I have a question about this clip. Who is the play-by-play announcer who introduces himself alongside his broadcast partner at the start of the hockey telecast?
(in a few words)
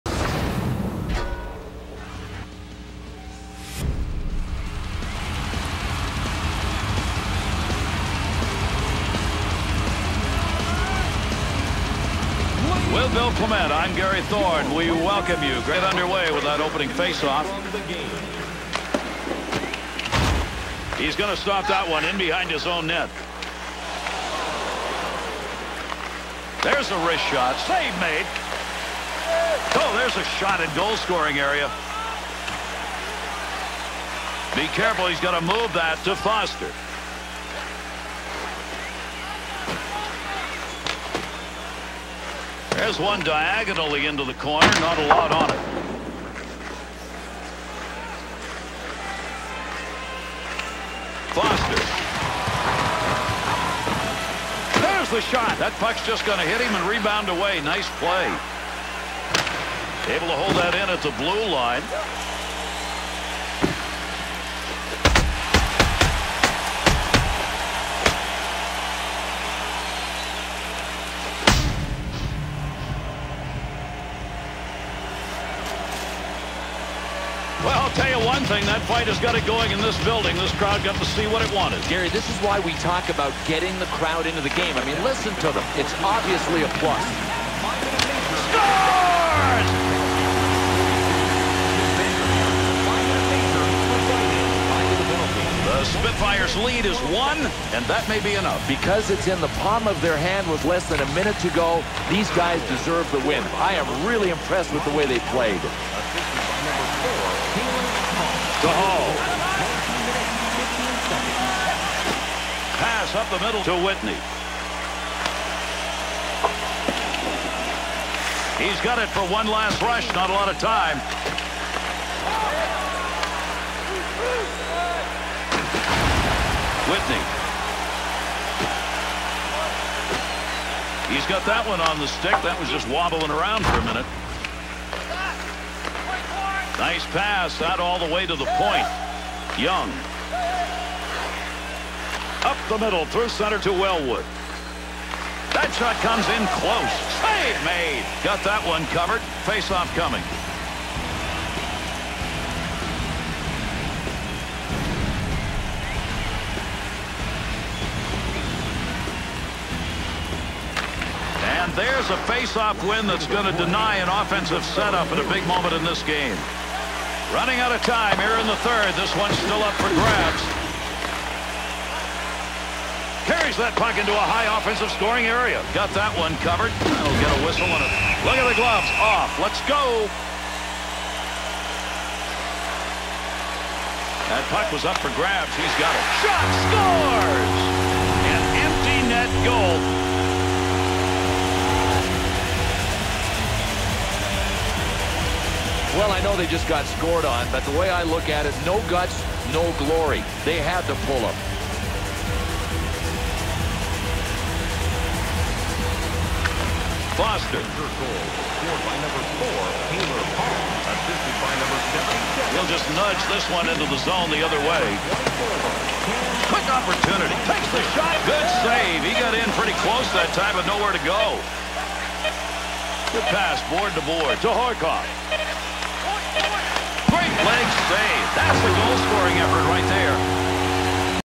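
Gary Thorne.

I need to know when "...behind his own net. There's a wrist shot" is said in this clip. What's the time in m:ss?
0:22.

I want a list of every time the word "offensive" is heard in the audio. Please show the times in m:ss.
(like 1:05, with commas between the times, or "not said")
2:44, 2:54.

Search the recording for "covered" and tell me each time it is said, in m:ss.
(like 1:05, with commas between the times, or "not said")
2:28, 2:56.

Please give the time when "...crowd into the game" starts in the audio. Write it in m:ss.
1:24.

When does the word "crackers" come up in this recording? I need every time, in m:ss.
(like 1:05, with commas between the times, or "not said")
not said.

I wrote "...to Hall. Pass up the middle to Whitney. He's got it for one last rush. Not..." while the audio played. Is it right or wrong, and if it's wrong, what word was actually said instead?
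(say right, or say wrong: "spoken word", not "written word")
right.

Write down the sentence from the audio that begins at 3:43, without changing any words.
Good pass, board to board, to Horcoff.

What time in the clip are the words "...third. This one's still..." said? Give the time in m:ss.
2:48.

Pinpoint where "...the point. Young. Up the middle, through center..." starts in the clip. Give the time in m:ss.
2:18.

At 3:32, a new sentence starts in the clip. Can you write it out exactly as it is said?
He'll just nudge this one into the zone the other way.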